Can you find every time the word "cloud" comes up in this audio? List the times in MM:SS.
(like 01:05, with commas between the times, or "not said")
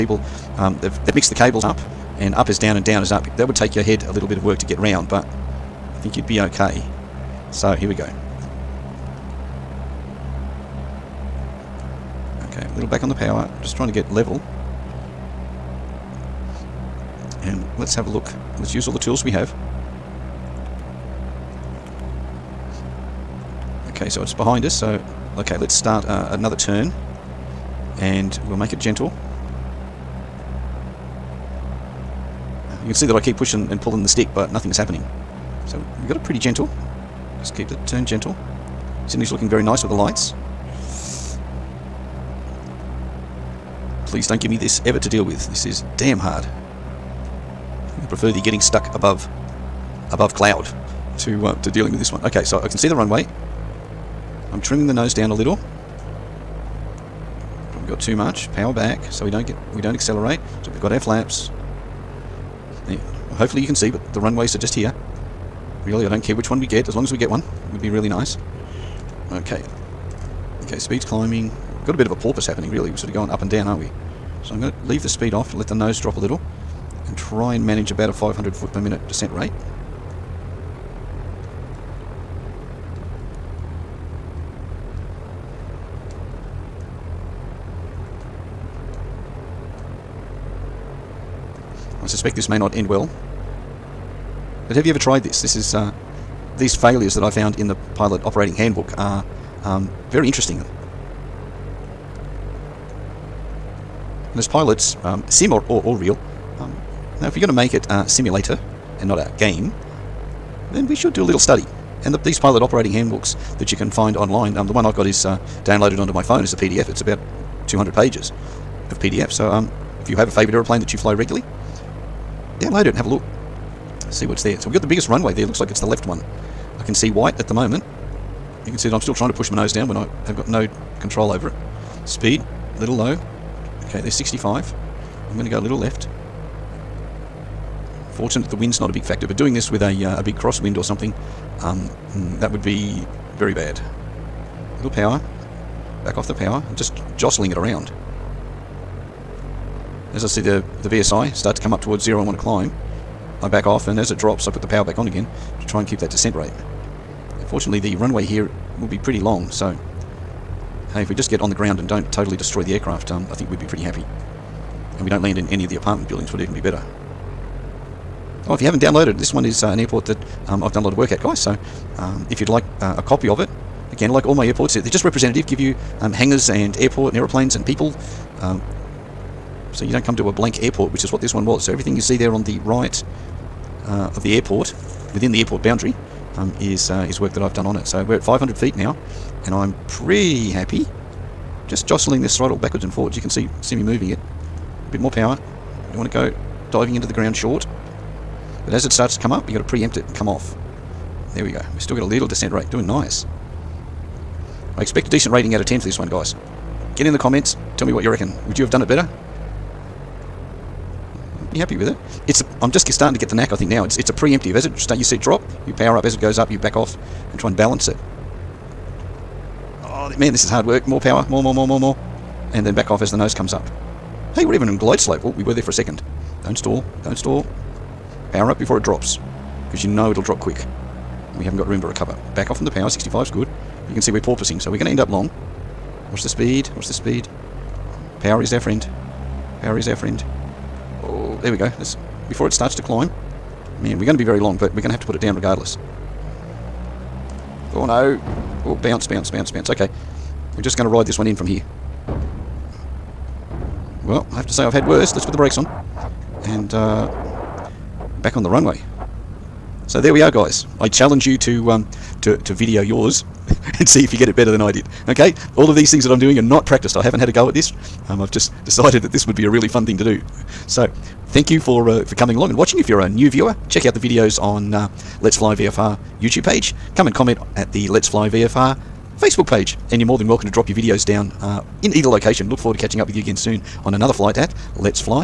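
00:50.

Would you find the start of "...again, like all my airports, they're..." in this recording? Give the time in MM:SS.
02:53.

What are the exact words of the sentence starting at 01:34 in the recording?
But have you ever tried this?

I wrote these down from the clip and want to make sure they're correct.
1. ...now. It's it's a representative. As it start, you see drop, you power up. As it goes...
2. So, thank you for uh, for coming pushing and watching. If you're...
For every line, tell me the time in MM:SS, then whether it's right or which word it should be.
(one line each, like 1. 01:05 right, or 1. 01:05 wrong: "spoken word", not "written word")
1. 03:33 wrong: "preemptive", not "representative"
2. 04:30 wrong: "along", not "pushing".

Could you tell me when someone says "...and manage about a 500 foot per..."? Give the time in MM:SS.
01:17.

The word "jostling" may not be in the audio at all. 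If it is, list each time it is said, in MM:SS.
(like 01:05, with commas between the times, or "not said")
02:27, 03:11.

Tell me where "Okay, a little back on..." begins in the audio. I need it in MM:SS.
00:12.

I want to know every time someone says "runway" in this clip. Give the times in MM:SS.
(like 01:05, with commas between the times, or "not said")
00:52, 01:04, 02:05, 02:37, 04:18.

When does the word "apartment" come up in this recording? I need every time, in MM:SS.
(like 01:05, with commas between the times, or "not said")
02:45.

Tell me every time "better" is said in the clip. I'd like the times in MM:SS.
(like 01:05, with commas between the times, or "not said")
02:46, 03:28, 04:24.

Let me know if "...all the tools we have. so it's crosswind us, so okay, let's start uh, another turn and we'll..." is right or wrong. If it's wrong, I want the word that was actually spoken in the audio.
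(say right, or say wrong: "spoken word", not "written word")
wrong: "behind", not "crosswind".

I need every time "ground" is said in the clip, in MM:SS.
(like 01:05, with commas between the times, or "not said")
02:41, 03:17.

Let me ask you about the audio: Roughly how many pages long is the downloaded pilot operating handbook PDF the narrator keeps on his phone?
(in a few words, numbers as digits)
200.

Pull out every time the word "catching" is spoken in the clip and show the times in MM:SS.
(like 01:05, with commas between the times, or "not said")
04:42.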